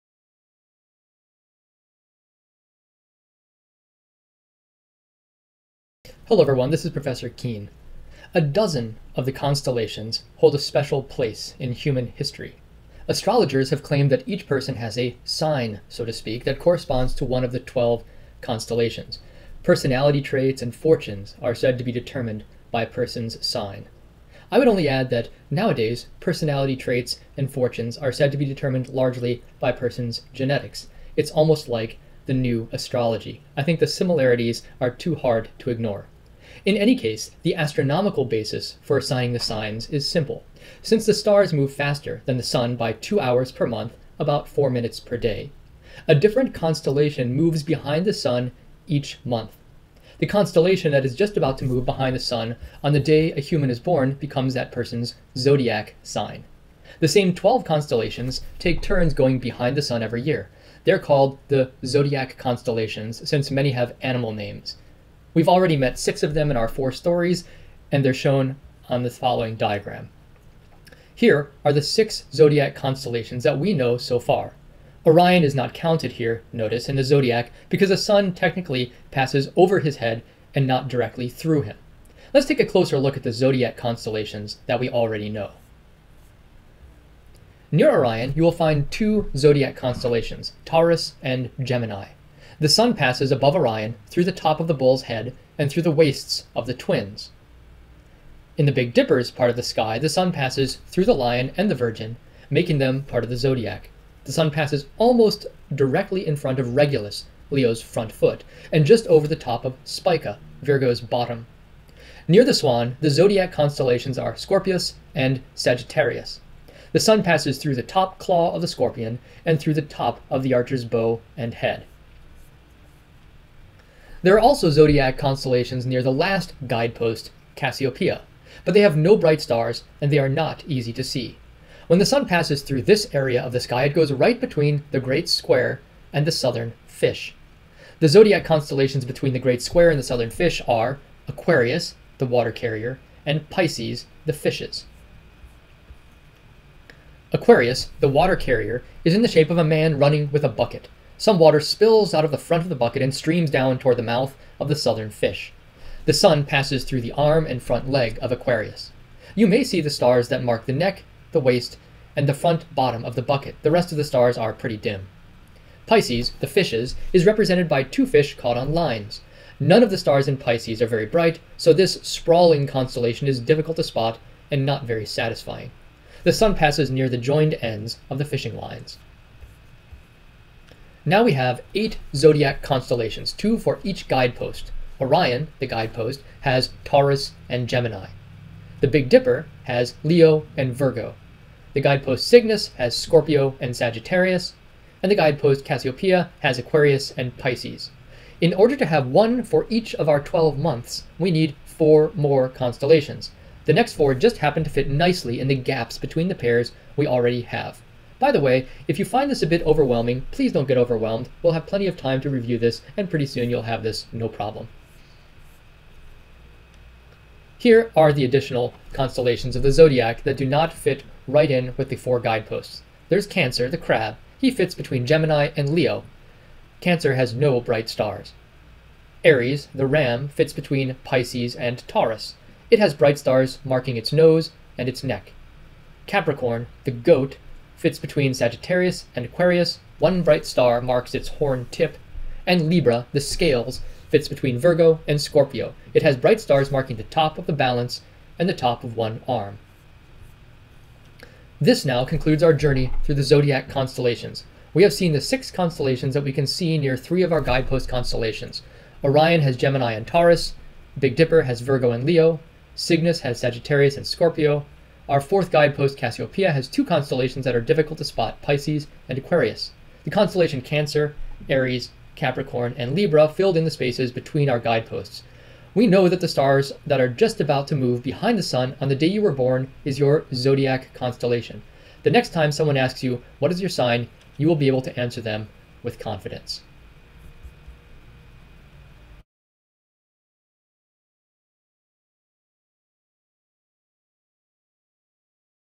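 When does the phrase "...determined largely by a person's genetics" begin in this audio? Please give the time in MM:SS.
00:28.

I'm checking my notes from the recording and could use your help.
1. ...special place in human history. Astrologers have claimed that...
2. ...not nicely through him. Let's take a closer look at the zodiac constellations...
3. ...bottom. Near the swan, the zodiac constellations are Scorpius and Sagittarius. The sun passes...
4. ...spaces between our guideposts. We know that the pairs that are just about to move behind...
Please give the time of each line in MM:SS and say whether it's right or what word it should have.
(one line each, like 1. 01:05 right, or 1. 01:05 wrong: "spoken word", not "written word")
1. 00:10 right
2. 01:20 wrong: "directly", not "nicely"
3. 01:50 right
4. 04:33 wrong: "stars", not "pairs".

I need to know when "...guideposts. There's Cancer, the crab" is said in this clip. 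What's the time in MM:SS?
03:42.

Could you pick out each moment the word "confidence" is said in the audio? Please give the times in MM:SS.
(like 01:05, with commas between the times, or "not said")
04:45.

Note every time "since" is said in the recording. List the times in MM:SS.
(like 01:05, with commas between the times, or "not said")
00:40, 01:03.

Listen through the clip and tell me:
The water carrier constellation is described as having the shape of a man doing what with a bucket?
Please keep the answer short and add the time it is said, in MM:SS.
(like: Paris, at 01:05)
Running, at 02:29.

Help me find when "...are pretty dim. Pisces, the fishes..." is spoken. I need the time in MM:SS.
02:44.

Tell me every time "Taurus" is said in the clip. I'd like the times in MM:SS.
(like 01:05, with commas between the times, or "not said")
01:30, 03:06, 03:51, 04:20.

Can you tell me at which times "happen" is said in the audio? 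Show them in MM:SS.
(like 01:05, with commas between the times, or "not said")
03:24.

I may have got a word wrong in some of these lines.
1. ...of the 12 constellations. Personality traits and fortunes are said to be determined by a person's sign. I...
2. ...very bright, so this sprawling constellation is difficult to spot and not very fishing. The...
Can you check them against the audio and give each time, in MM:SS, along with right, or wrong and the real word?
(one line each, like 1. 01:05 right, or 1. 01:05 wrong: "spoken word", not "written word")
1. 00:17 right
2. 02:50 wrong: "satisfying", not "fishing".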